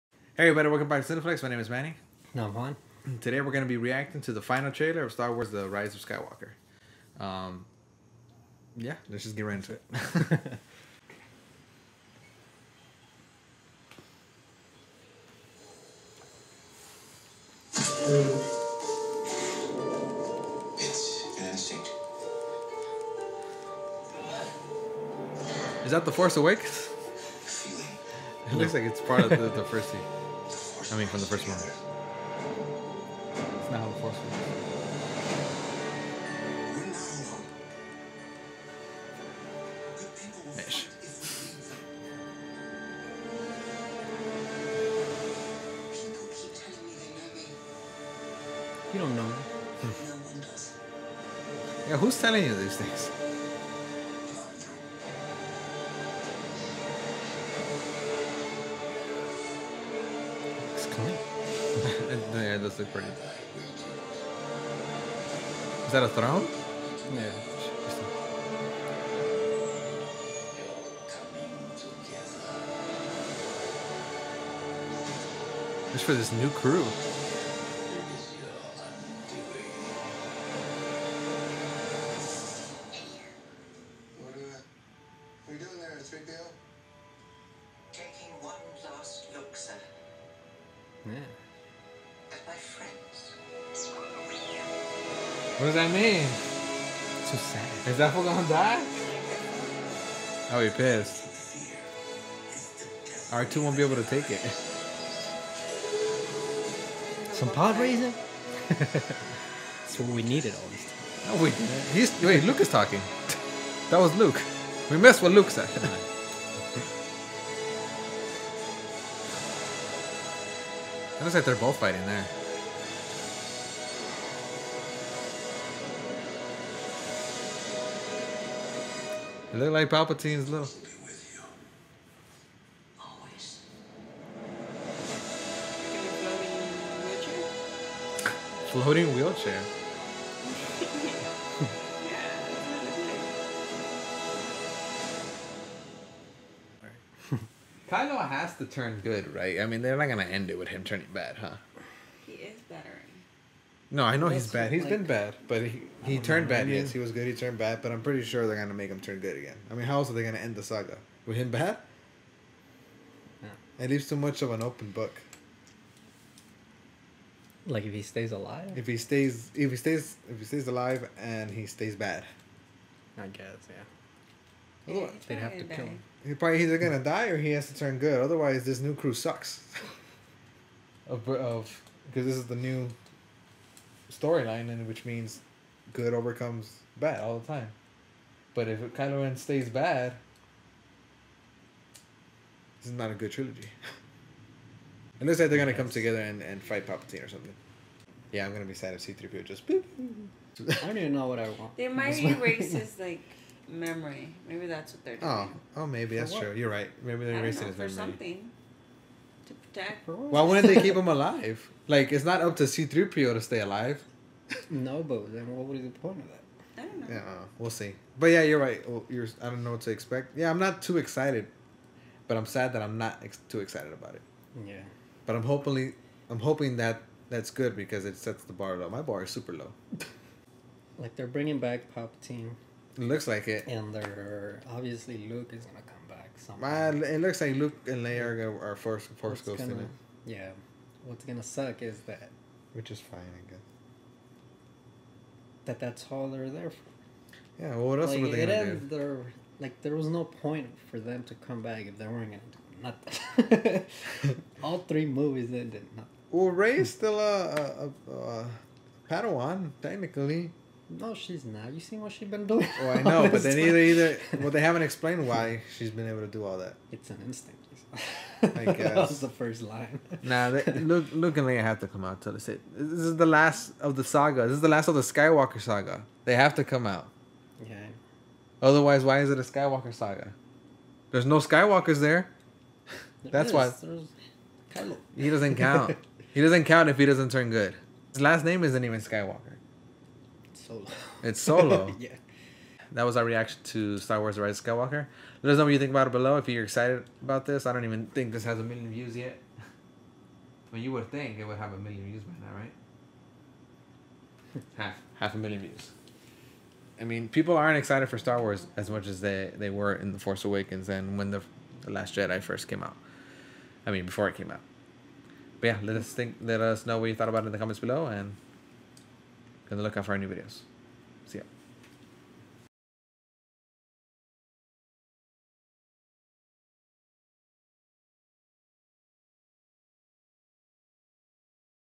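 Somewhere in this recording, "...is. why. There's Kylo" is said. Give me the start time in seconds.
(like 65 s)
283 s.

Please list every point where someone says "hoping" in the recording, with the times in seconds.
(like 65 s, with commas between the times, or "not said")
226 s.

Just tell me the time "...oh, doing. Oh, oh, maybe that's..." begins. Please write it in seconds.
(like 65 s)
205 s.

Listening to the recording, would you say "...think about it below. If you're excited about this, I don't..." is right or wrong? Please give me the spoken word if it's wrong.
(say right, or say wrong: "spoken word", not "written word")
right.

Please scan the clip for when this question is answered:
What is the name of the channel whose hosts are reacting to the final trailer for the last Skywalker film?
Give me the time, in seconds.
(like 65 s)
1 s.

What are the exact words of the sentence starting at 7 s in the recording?
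Um, yeah, let's just get right into it.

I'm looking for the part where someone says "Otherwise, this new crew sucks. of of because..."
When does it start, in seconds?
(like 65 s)
178 s.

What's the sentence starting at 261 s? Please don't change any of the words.
You seen what she's been doing?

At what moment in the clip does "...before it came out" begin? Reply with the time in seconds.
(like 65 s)
314 s.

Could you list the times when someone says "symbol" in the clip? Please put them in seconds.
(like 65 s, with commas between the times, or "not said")
not said.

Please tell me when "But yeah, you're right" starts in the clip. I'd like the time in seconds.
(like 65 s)
218 s.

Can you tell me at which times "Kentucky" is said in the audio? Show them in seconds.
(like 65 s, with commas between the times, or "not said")
not said.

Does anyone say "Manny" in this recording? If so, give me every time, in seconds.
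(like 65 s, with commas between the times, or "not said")
1 s.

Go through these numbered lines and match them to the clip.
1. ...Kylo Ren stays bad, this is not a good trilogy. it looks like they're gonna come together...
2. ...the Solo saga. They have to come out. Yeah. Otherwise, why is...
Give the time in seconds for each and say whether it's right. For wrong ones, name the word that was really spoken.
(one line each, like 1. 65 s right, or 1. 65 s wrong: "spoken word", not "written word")
1. 188 s right
2. 274 s wrong: "Skywalker", not "Solo".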